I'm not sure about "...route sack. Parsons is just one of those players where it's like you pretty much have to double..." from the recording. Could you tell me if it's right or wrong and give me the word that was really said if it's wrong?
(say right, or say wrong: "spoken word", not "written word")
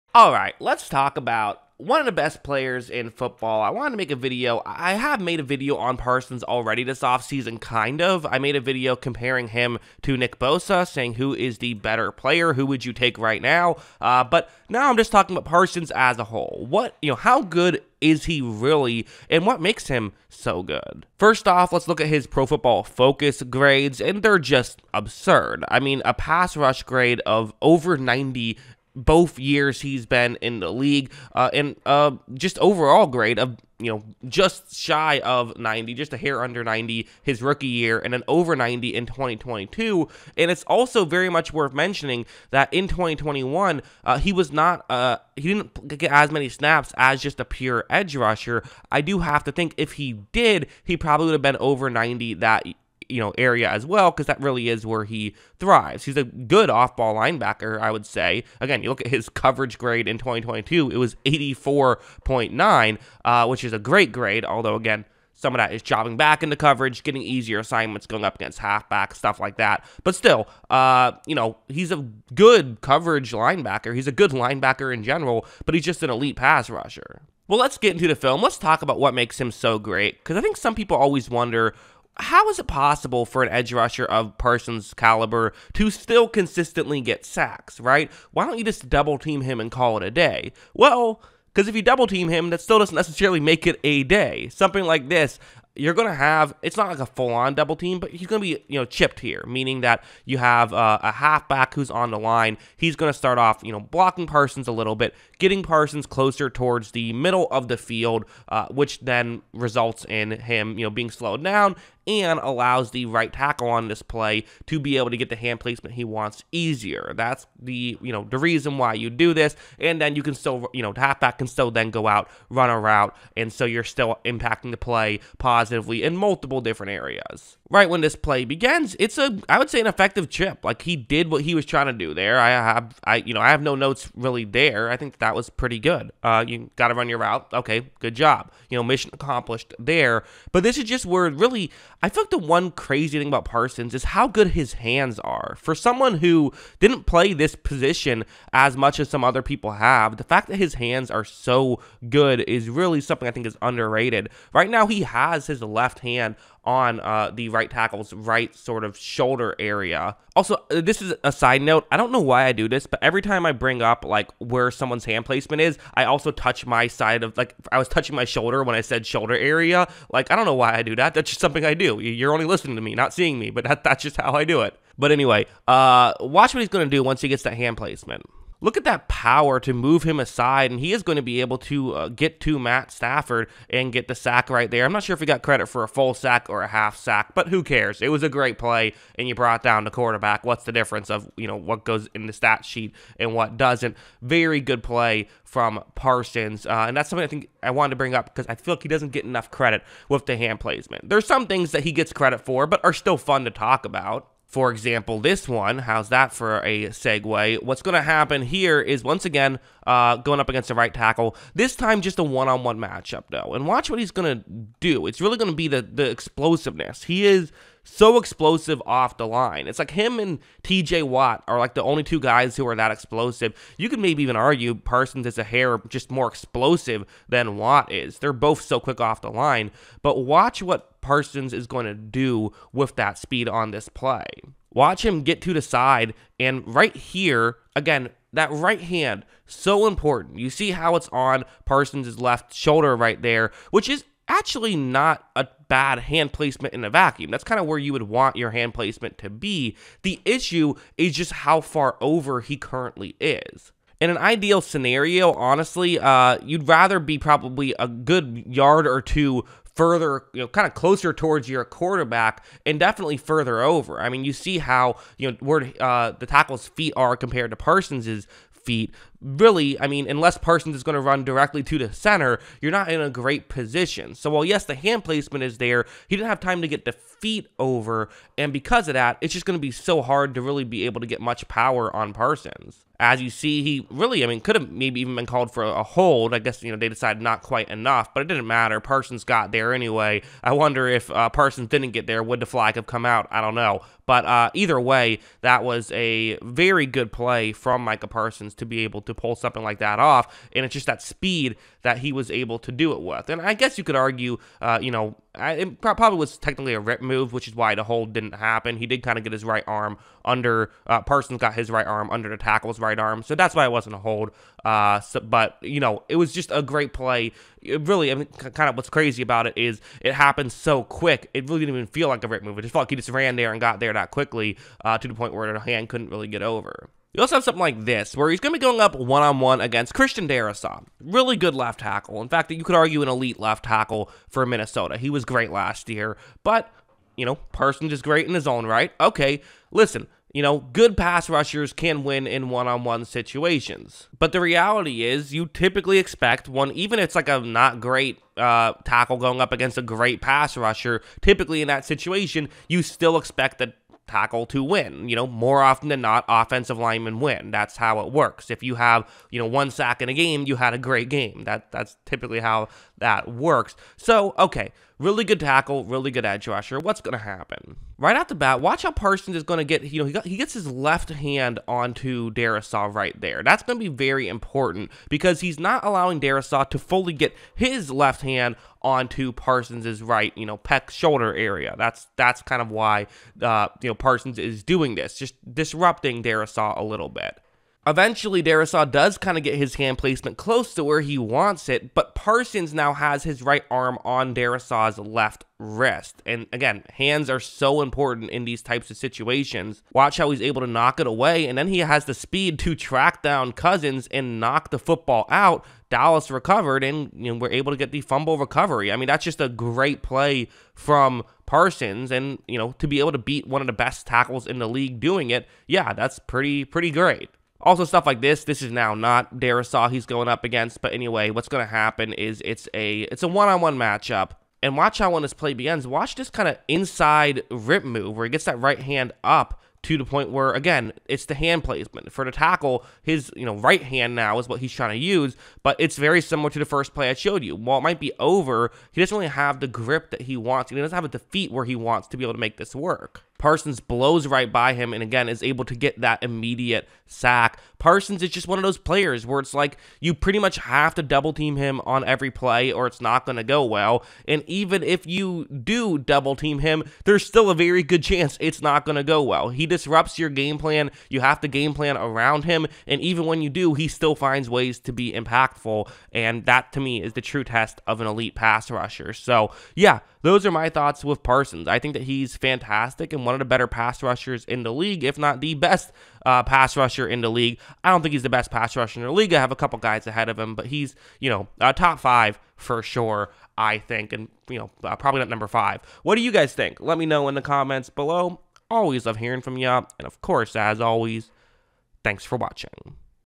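wrong: "immediate", not "route".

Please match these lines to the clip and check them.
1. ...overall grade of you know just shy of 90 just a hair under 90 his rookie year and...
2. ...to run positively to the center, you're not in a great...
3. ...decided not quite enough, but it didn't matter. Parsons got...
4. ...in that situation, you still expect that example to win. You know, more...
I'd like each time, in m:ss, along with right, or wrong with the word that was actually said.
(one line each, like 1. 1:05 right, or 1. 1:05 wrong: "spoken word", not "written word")
1. 0:32 right
2. 4:30 wrong: "directly", not "positively"
3. 4:46 right
4. 5:51 wrong: "tackle", not "example".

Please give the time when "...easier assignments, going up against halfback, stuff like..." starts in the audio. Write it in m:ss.
1:07.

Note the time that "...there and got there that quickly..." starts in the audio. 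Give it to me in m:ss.
5:23.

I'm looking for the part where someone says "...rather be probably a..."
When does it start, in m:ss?
4:16.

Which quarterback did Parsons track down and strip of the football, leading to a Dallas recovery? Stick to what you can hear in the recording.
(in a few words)
Cousins.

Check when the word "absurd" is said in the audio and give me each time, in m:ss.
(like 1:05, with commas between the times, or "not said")
0:24.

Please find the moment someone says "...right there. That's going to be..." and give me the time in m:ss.
6:12.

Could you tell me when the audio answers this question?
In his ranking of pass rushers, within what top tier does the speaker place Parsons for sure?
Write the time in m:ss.
8:01.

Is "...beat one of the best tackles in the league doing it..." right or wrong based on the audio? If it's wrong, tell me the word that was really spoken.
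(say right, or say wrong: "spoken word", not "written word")
right.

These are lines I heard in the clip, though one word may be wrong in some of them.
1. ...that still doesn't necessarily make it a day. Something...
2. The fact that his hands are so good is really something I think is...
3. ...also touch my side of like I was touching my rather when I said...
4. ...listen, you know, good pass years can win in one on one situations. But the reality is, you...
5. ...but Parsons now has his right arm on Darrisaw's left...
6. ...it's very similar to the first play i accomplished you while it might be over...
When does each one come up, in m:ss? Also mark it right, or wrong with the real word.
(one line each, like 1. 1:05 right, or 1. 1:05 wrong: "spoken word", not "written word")
1. 1:32 right
2. 2:30 right
3. 2:46 wrong: "shoulder", not "rather"
4. 5:39 wrong: "rushers", not "years"
5. 6:31 right
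6. 7:15 wrong: "showed", not "accomplished".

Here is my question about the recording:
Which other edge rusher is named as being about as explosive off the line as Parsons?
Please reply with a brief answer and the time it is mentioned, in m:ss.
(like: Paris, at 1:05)
TJ Watt, at 3:40.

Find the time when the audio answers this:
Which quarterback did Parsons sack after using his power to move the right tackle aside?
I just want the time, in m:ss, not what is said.
3:02.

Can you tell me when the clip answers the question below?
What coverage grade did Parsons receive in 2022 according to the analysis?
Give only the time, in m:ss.
1:01.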